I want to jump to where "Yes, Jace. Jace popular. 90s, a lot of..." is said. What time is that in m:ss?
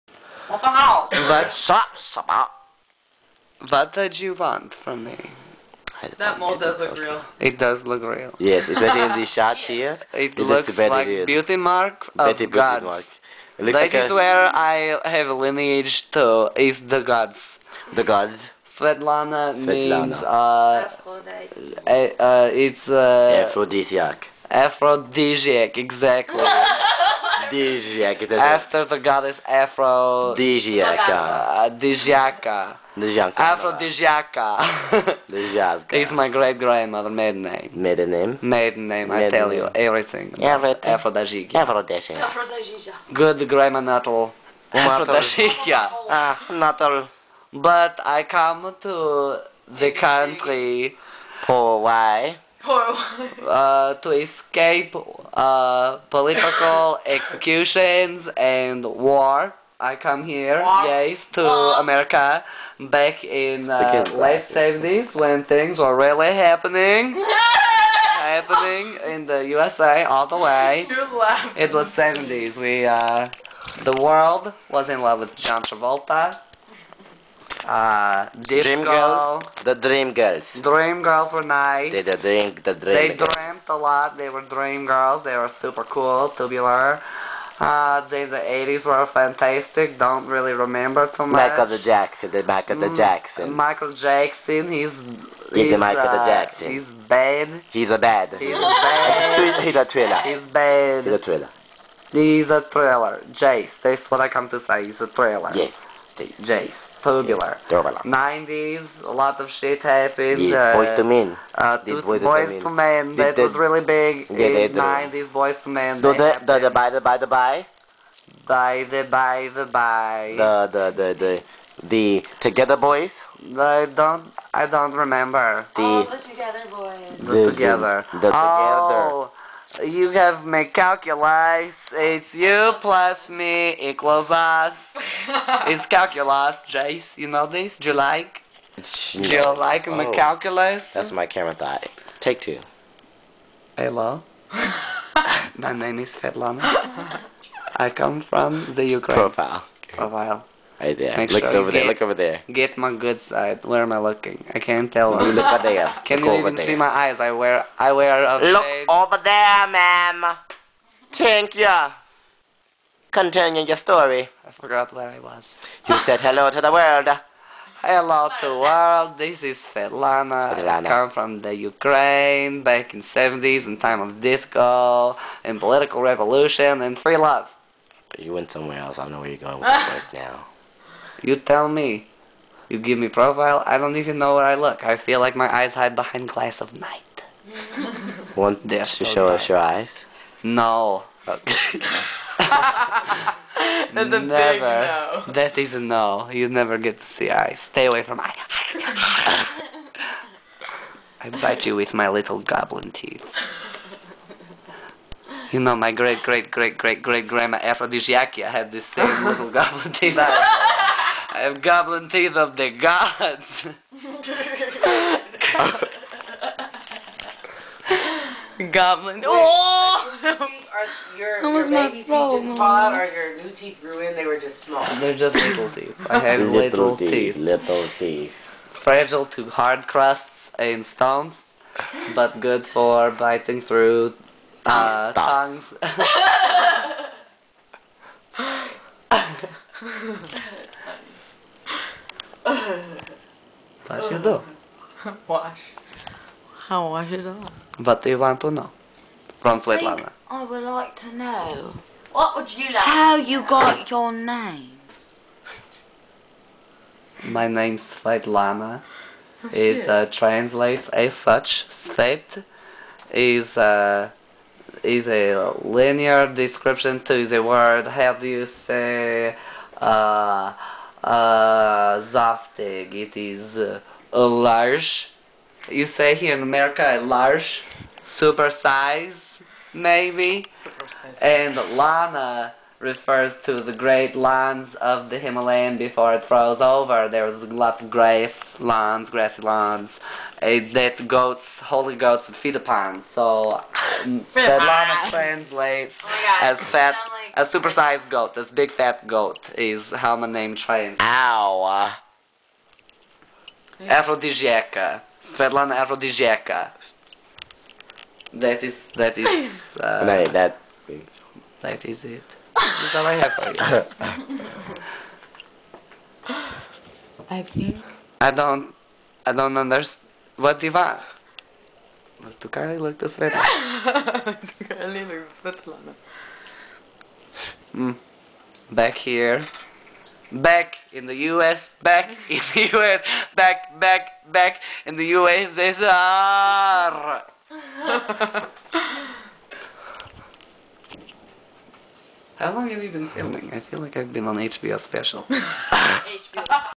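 1:45.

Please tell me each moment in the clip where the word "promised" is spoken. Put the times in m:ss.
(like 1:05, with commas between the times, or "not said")
not said.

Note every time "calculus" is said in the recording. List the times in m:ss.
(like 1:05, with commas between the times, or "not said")
2:10, 2:15, 2:20.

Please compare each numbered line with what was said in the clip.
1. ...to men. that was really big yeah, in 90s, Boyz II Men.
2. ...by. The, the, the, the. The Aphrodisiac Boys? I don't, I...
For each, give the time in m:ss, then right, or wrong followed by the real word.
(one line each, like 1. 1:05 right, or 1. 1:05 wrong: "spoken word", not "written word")
1. 1:53 right
2. 1:59 wrong: "Together", not "Aphrodisiac".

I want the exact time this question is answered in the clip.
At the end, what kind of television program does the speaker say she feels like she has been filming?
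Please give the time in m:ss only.
5:44.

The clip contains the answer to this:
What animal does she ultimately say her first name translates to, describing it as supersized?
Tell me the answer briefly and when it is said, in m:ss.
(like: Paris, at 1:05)
big fat goat, at 4:58.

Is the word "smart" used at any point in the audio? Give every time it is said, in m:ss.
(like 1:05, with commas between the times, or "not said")
not said.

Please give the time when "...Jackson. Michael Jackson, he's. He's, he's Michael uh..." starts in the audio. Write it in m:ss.
1:32.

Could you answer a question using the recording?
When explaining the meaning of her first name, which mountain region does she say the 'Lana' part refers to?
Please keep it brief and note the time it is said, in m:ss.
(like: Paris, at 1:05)
Himalayan, at 4:45.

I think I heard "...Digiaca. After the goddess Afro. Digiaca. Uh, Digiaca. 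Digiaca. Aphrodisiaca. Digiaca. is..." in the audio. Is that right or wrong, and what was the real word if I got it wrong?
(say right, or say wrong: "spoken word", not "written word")
right.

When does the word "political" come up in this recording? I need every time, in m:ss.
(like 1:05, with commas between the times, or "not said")
0:56, 2:55.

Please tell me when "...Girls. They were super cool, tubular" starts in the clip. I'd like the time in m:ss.
1:24.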